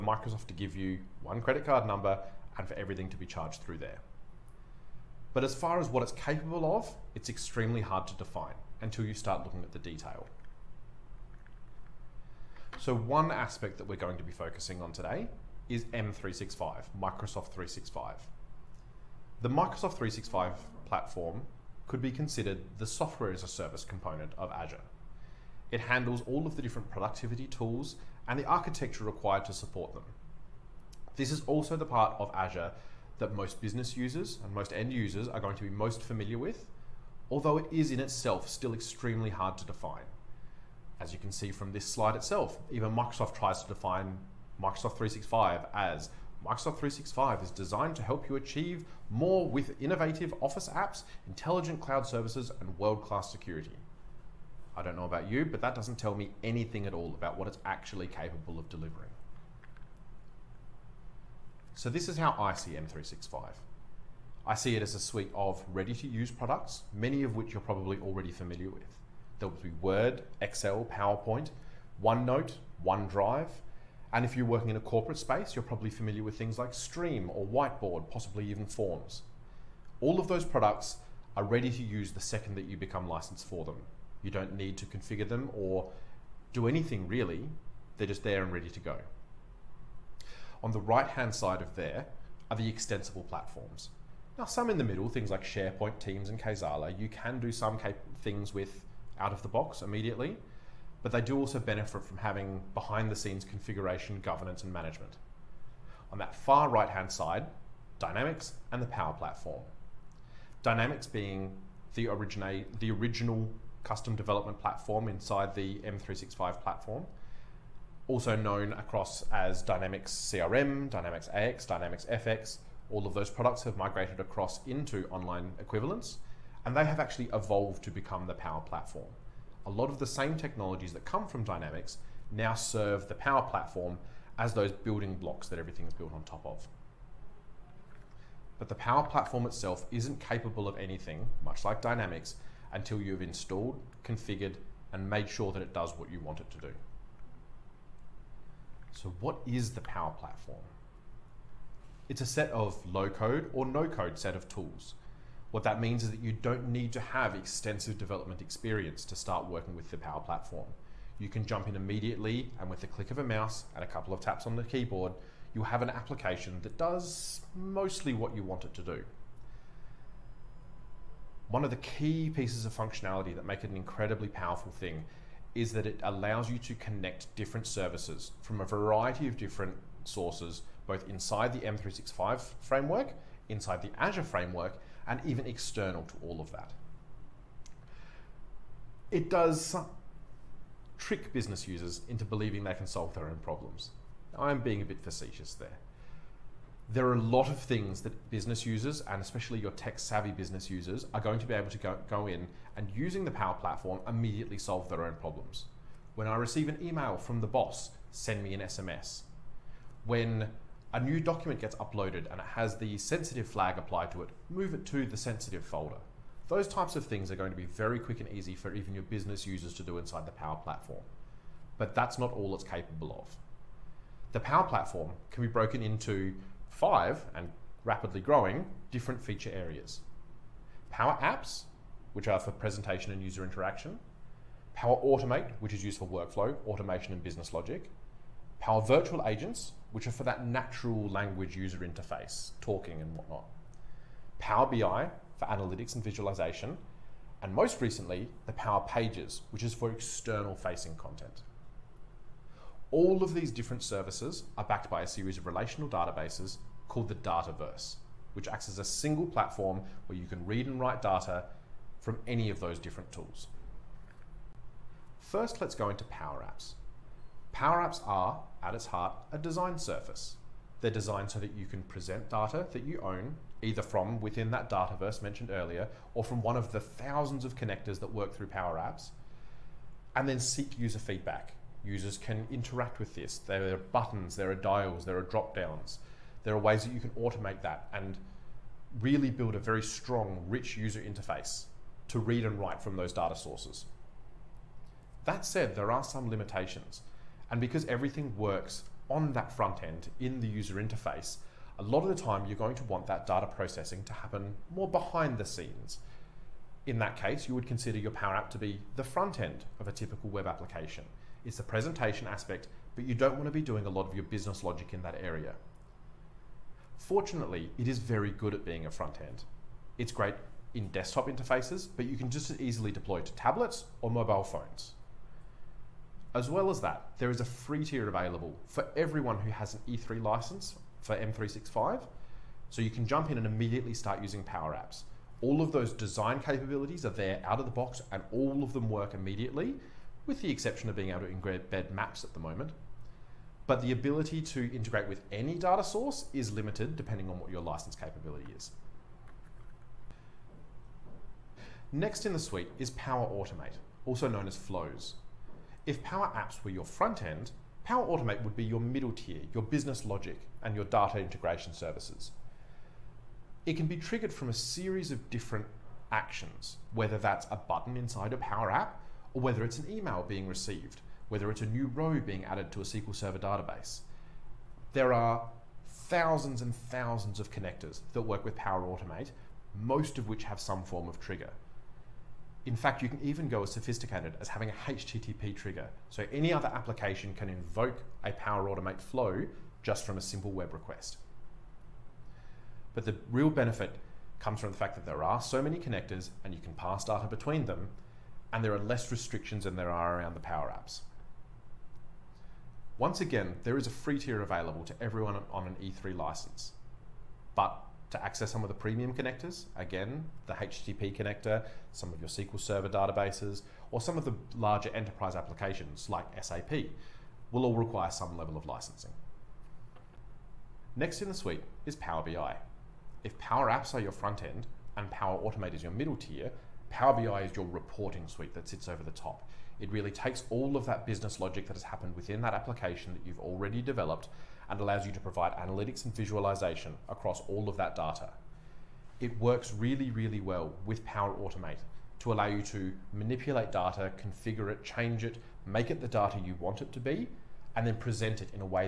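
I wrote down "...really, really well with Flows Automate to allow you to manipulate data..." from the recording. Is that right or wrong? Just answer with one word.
wrong.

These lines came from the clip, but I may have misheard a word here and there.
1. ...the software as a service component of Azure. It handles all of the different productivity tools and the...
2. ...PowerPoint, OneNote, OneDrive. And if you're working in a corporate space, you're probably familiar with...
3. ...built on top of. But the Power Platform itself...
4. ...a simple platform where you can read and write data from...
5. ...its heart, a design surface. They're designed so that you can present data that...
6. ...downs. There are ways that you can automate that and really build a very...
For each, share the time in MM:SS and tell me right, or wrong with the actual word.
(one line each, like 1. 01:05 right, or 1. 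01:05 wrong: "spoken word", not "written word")
1. 00:22 right
2. 01:10 right
3. 02:15 right
4. 04:18 wrong: "single", not "simple"
5. 04:28 right
6. 04:45 right.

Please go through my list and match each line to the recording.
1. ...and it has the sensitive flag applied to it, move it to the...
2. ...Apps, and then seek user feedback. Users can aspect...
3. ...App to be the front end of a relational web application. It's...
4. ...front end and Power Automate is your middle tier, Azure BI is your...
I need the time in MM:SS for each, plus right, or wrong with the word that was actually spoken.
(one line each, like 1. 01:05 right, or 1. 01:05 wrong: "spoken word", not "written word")
1. 03:32 right
2. 04:38 wrong: "interact", not "aspect"
3. 05:08 wrong: "typical", not "relational"
4. 07:04 wrong: "Power", not "Azure".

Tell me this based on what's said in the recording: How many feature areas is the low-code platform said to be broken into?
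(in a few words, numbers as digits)
5.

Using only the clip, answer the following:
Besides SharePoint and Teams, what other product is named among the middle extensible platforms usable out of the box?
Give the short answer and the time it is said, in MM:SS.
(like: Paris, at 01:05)
Kaizala, at 01:36.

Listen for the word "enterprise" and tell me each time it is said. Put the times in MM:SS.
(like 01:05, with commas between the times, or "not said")
06:54.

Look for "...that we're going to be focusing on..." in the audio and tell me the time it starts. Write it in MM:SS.
00:13.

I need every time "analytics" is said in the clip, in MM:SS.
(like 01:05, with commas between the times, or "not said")
04:05, 07:15.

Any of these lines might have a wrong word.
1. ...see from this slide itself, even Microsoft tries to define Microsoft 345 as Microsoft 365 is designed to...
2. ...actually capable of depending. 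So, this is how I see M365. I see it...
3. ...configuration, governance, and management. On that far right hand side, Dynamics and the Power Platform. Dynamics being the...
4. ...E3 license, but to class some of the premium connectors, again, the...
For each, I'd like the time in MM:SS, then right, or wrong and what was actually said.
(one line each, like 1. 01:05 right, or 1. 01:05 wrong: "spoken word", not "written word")
1. 00:41 wrong: "365", not "345"
2. 00:57 wrong: "delivering", not "depending"
3. 01:43 right
4. 06:45 wrong: "access", not "class".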